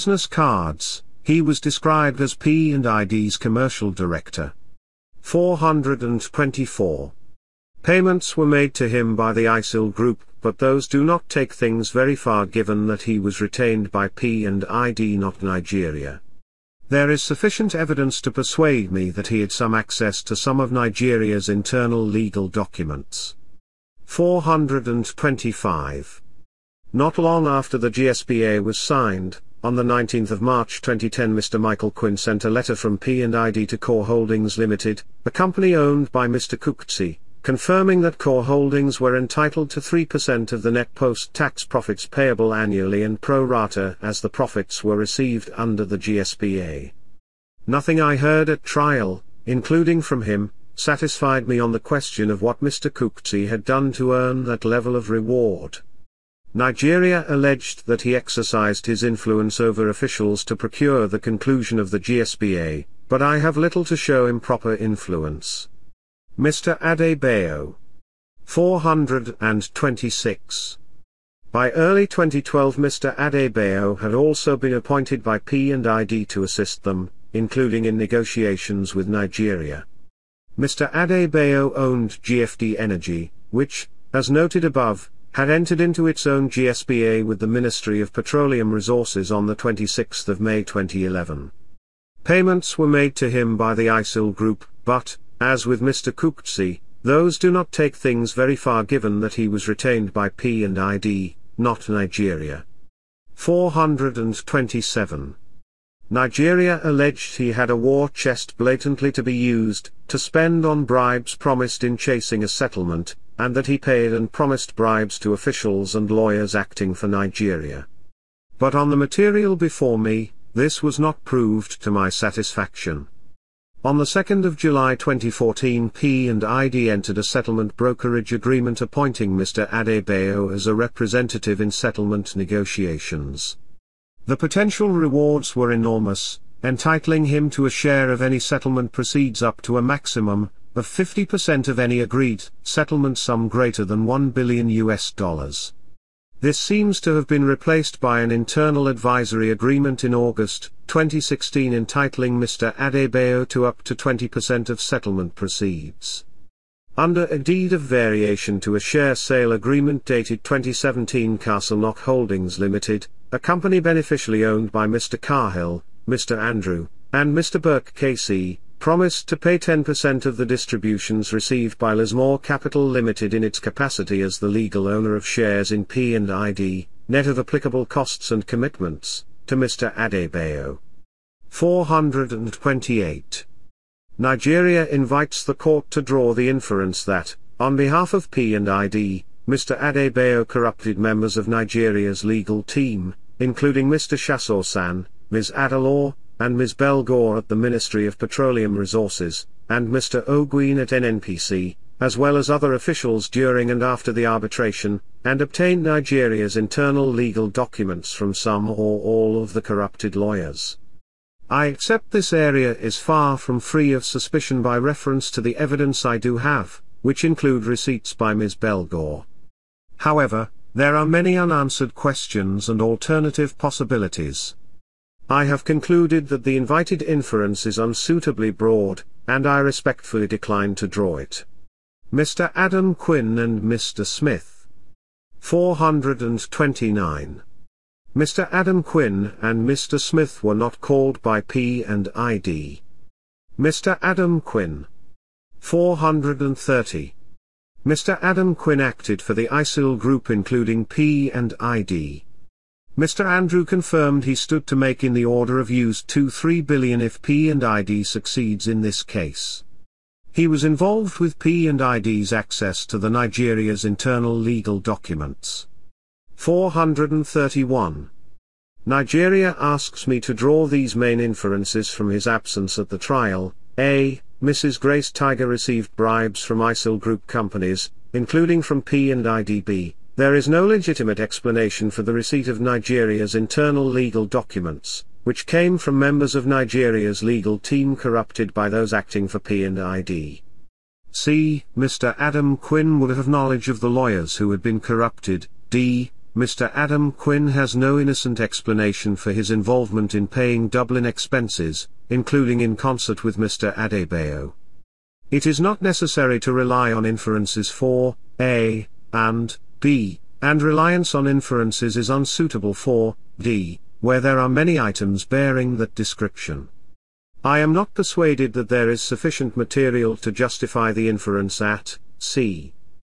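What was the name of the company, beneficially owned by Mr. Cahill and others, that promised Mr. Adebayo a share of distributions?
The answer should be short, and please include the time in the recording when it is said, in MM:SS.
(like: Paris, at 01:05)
Castle Knock Holdings Limited, at 02:41.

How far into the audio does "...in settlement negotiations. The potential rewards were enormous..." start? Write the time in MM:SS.
02:11.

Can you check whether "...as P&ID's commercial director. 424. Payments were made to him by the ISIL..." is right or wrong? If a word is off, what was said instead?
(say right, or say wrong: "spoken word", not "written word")
right.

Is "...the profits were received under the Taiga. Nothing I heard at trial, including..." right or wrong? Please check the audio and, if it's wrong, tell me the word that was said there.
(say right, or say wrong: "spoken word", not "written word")
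wrong: "GSPA", not "Taiga".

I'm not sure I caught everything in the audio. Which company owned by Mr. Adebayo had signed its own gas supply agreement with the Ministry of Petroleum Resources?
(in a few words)
GFD Energy.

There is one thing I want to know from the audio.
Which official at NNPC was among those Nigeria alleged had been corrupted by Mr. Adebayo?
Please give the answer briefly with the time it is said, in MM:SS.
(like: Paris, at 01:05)
Mr. Oguine, at 03:19.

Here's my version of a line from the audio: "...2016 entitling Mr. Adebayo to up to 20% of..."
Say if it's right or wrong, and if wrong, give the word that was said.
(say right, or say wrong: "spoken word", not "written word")
right.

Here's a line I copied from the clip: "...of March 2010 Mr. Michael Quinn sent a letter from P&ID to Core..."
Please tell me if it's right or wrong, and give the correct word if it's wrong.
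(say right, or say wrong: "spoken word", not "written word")
right.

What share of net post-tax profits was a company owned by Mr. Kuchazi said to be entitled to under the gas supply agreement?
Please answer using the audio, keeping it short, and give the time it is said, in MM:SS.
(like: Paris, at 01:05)
3%, at 00:39.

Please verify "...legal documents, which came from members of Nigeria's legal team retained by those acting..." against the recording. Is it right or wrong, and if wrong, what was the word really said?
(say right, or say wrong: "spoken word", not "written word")
wrong: "corrupted", not "retained".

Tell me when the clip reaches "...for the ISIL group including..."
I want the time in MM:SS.
04:09.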